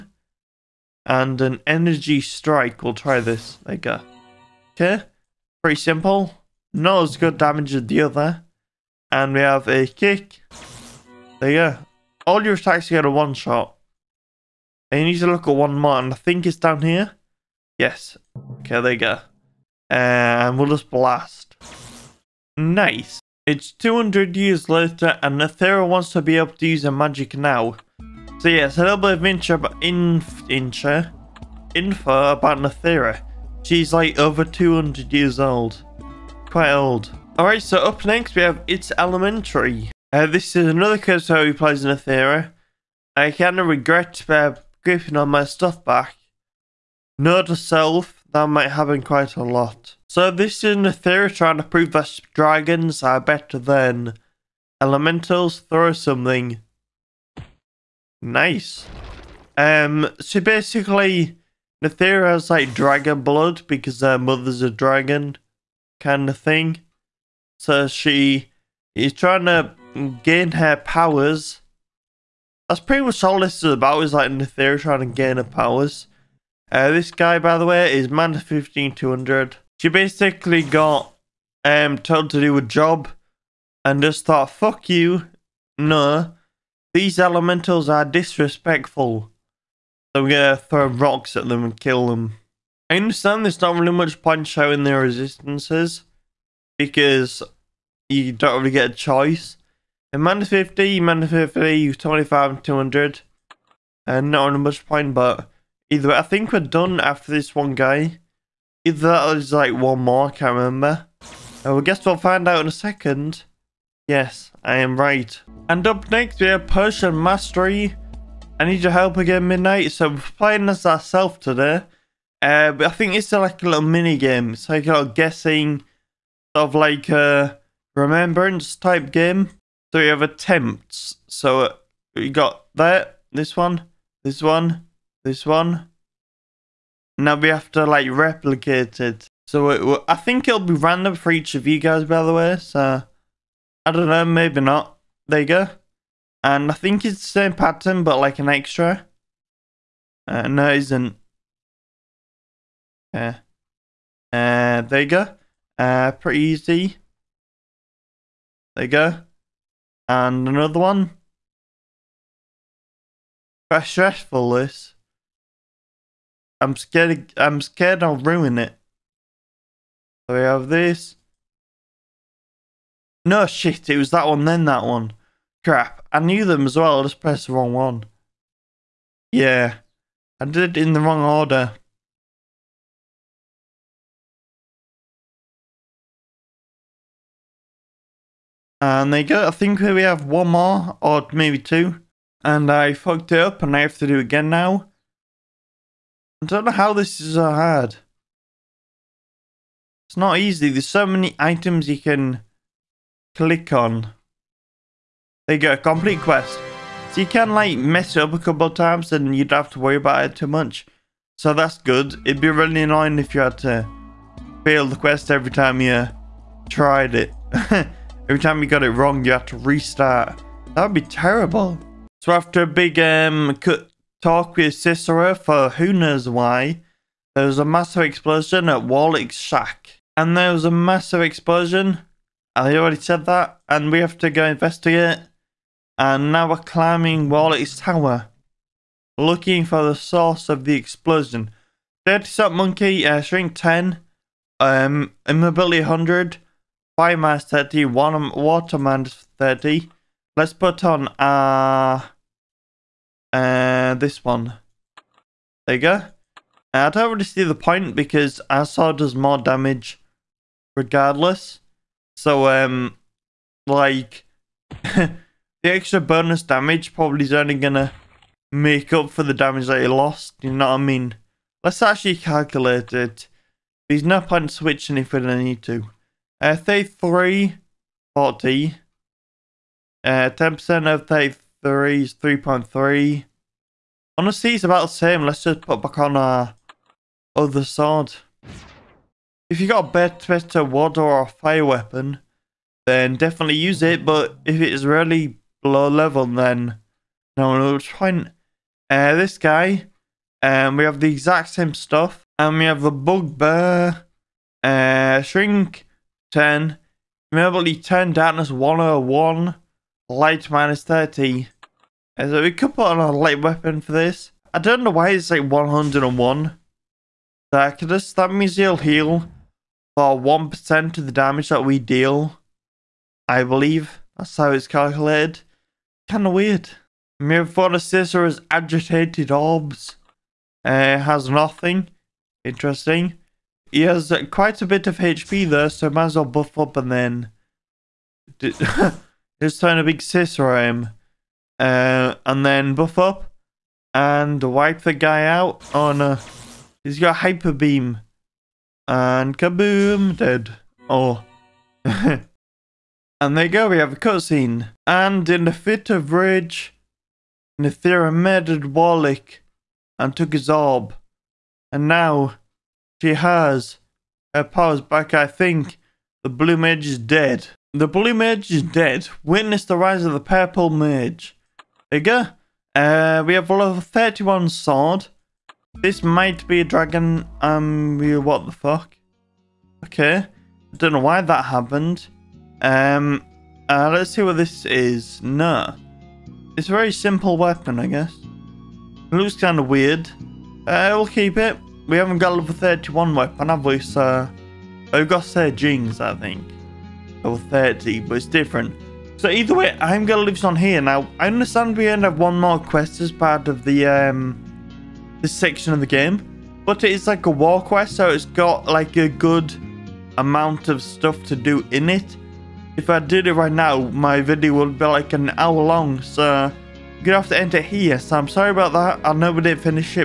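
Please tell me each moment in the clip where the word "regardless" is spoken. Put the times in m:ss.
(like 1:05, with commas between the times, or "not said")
4:20.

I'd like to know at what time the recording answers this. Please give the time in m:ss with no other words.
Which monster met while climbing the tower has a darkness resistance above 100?
5:02.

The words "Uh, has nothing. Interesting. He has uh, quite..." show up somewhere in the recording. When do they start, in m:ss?
5:30.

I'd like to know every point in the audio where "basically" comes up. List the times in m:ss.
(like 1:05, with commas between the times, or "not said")
1:00, 1:19.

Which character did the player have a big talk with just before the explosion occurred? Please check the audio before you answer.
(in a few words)
Cysero.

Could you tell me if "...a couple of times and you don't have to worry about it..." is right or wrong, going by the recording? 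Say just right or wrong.
right.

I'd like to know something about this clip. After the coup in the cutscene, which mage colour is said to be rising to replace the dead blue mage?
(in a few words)
purple.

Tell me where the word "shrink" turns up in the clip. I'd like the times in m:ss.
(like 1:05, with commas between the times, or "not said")
4:03, 5:05.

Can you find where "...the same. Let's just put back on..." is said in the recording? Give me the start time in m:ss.
4:44.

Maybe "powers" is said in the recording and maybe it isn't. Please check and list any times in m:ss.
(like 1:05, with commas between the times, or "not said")
1:10, 1:15, 6:04.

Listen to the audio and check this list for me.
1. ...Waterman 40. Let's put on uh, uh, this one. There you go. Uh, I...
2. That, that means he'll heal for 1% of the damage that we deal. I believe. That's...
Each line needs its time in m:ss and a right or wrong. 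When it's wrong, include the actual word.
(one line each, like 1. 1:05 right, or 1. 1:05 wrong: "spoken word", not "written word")
1. 4:08 wrong: "30", not "40"
2. 5:17 right.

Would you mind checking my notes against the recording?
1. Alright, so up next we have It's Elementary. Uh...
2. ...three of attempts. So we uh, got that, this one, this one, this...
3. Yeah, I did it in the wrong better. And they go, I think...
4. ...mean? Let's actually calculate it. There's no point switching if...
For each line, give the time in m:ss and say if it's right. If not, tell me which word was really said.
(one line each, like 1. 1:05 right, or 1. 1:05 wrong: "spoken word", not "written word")
1. 0:37 right
2. 2:09 right
3. 2:59 wrong: "order", not "better"
4. 4:30 right.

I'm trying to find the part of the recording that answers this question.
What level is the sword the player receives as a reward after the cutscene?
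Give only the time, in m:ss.
6:13.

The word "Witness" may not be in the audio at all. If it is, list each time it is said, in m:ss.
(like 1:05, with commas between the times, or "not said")
6:09.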